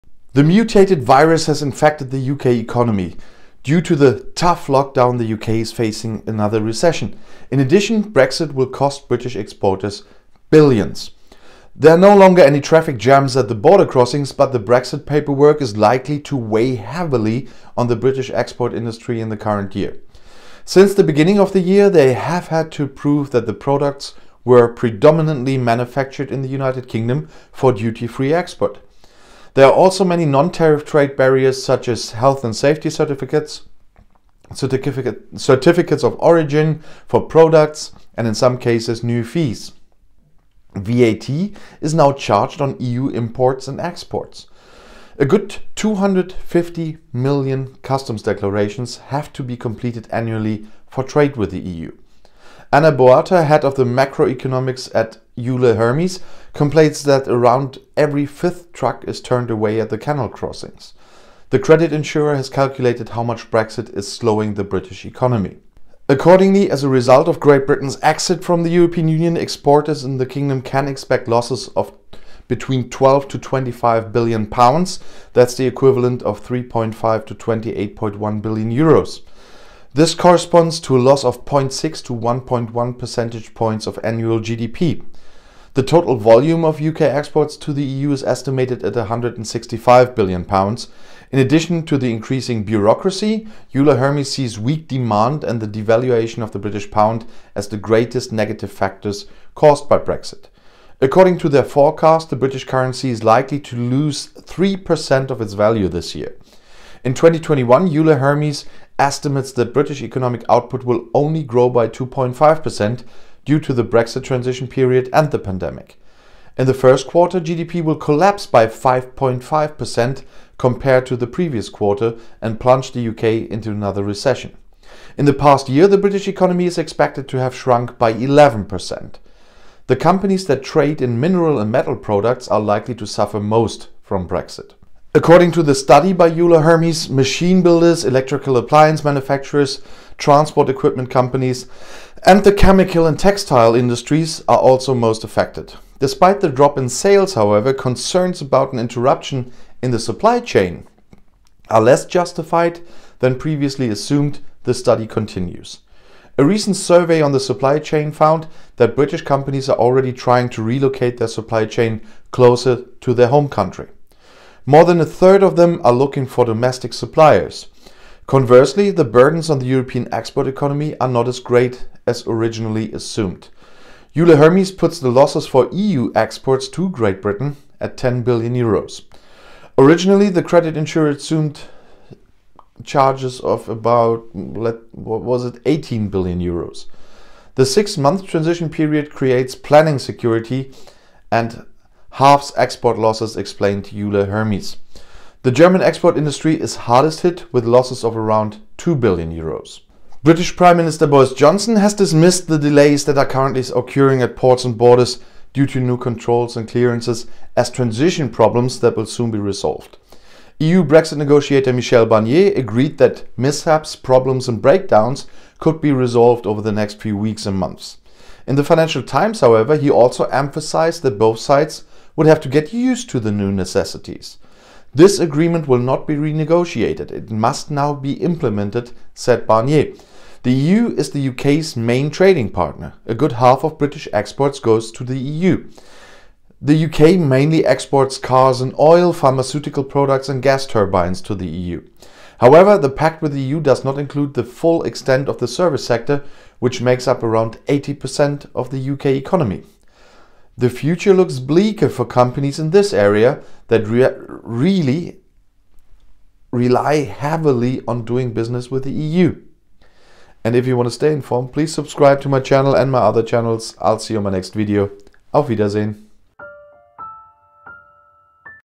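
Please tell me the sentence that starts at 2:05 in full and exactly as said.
In the past year, the British economy is expected to have shrunk by 11%.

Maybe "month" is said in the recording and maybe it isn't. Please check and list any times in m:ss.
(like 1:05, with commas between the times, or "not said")
3:07, 3:37.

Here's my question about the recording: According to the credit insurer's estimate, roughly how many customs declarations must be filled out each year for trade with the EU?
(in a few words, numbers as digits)
250 million.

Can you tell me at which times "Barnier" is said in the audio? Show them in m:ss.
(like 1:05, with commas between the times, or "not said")
3:32, 3:49.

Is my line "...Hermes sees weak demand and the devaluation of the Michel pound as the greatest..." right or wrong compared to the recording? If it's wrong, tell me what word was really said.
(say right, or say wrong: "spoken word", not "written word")
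wrong: "British", not "Michel".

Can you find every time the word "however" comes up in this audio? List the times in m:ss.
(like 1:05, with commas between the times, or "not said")
2:27, 3:39, 4:02.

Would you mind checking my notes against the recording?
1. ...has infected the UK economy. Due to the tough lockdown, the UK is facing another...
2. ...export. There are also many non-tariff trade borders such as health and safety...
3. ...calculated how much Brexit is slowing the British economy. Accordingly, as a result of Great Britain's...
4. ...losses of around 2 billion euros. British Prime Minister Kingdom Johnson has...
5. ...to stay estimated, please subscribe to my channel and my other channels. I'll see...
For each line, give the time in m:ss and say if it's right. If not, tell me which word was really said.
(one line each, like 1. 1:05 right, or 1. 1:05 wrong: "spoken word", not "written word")
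1. 0:01 right
2. 0:28 wrong: "barriers", not "borders"
3. 1:02 right
4. 3:17 wrong: "Boris", not "Kingdom"
5. 4:20 wrong: "informed", not "estimated".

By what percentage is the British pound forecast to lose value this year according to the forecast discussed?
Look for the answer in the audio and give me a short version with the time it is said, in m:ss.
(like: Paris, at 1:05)
3%, at 1:44.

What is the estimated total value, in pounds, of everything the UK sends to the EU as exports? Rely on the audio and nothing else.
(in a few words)
165 billion pounds.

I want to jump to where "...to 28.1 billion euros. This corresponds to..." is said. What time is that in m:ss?
1:17.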